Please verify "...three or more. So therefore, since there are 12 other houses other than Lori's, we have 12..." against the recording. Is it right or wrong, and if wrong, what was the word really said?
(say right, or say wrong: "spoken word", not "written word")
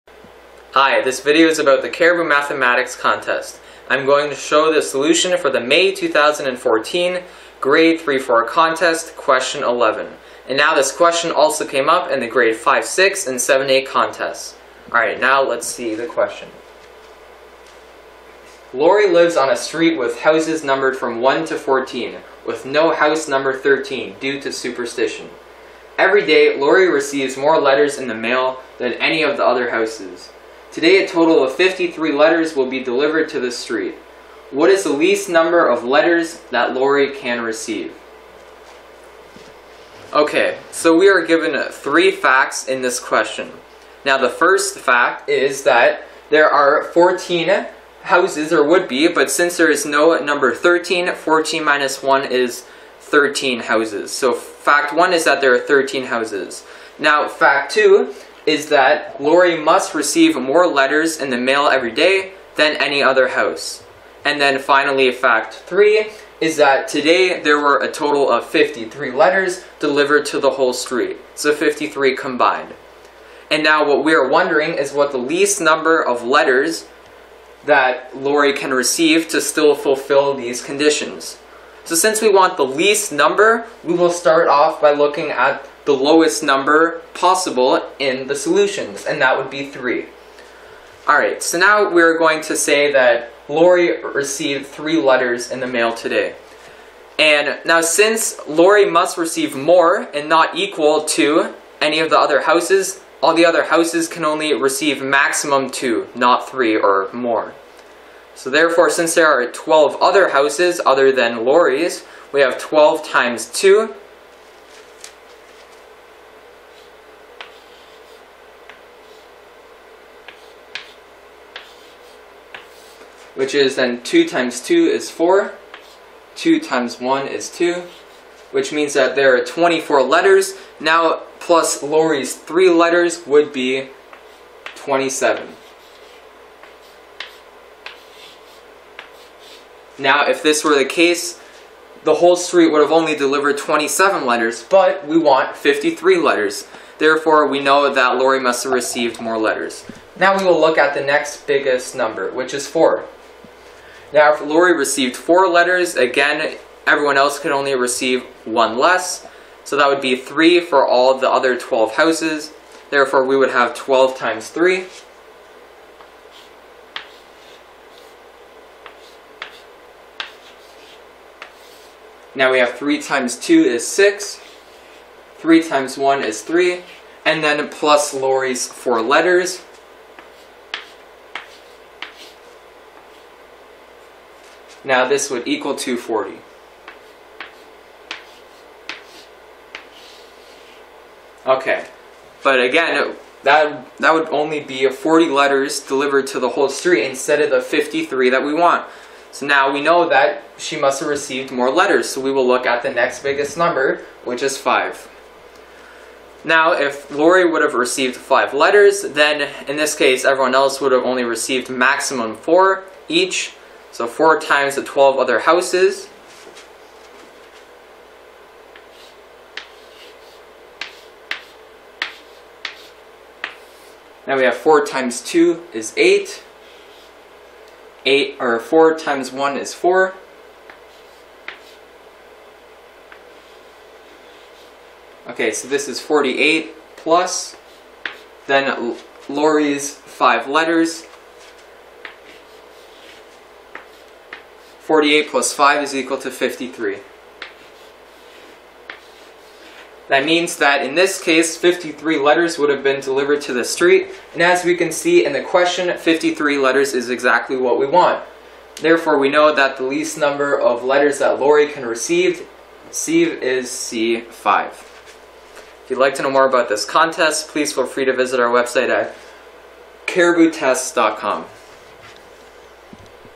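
right.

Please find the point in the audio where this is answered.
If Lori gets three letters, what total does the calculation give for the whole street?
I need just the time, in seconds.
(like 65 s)
133 s.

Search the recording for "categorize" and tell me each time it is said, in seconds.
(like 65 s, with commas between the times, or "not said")
not said.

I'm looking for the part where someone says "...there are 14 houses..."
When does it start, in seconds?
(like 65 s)
46 s.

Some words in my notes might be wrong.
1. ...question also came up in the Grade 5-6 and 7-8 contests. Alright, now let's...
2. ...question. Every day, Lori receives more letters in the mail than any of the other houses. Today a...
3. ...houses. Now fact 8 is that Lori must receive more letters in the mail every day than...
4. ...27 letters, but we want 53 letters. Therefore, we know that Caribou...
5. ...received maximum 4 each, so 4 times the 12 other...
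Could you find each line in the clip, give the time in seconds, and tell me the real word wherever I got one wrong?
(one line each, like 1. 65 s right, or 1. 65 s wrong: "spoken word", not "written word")
1. 10 s right
2. 24 s wrong: "superstition", not "question"
3. 56 s wrong: "2", not "8"
4. 143 s wrong: "Lori", not "Caribou"
5. 211 s right.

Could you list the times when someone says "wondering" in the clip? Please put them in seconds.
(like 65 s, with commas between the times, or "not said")
74 s.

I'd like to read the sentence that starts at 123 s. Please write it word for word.
Which is then 2 times 2 is 4.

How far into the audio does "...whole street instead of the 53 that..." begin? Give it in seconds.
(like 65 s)
196 s.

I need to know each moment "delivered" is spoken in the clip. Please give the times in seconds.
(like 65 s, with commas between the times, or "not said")
32 s, 69 s, 143 s, 195 s, 252 s.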